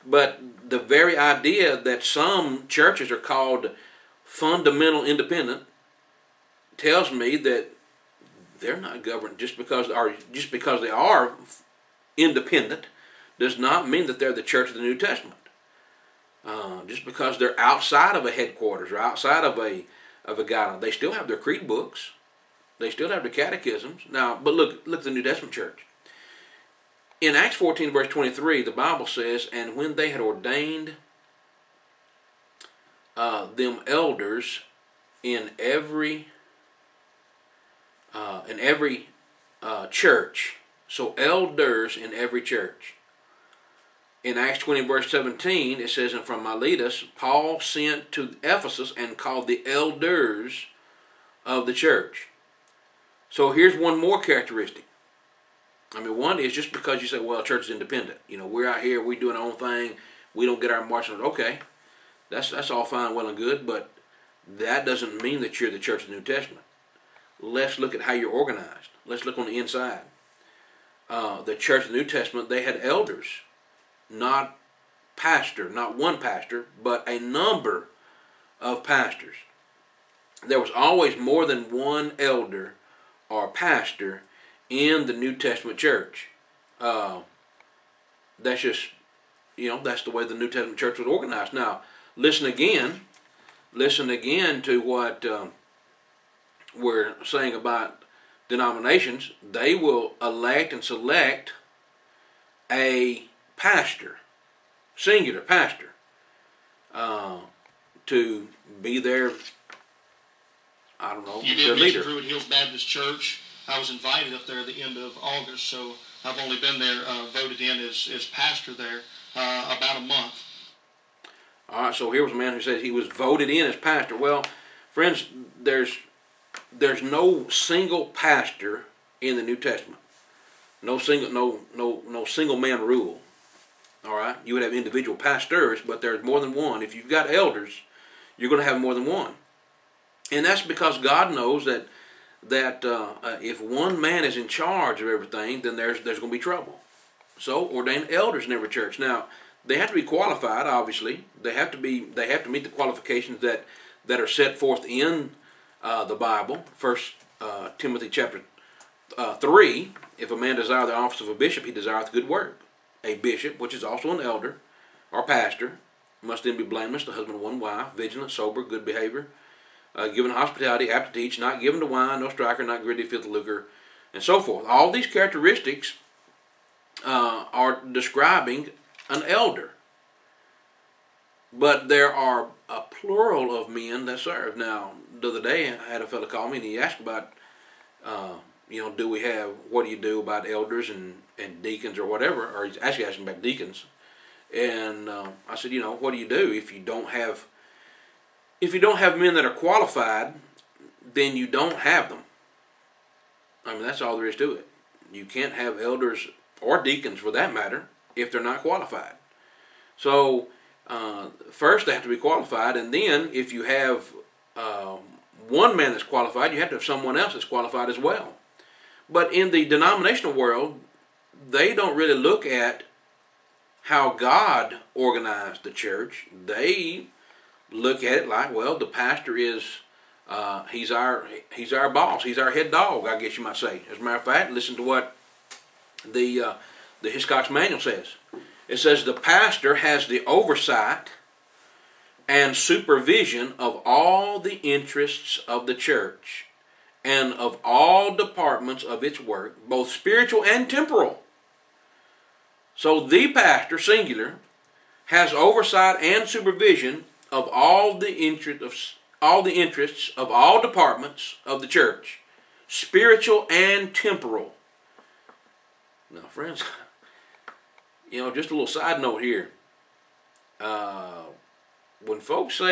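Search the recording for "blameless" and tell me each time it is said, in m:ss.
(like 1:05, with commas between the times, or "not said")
2:46.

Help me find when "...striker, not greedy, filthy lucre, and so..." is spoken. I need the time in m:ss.
2:52.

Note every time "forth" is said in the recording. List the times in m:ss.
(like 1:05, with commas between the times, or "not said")
2:34, 2:54.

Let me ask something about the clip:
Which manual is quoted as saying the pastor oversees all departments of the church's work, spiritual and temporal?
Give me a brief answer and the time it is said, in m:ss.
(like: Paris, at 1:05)
Hiscox manual, at 3:57.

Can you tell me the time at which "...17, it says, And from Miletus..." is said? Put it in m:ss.
0:45.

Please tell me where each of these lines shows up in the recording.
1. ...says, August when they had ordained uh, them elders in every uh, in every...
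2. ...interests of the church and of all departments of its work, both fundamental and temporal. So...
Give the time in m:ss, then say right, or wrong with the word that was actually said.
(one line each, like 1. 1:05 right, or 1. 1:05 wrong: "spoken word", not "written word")
1. 0:29 wrong: "And", not "August"
2. 4:04 wrong: "spiritual", not "fundamental".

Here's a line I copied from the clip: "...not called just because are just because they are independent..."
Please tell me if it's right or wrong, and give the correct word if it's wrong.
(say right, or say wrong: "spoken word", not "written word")
wrong: "governed", not "called".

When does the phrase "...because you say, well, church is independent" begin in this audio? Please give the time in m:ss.
0:56.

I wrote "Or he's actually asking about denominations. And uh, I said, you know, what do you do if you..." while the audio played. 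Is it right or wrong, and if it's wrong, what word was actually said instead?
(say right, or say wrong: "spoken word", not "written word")
wrong: "deacons", not "denominations".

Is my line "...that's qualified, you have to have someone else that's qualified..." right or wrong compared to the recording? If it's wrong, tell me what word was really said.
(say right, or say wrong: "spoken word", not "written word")
right.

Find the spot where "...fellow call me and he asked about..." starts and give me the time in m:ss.
3:06.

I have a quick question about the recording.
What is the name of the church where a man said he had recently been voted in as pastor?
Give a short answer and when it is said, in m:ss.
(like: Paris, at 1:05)
Druid Hills Baptist Church, at 1:52.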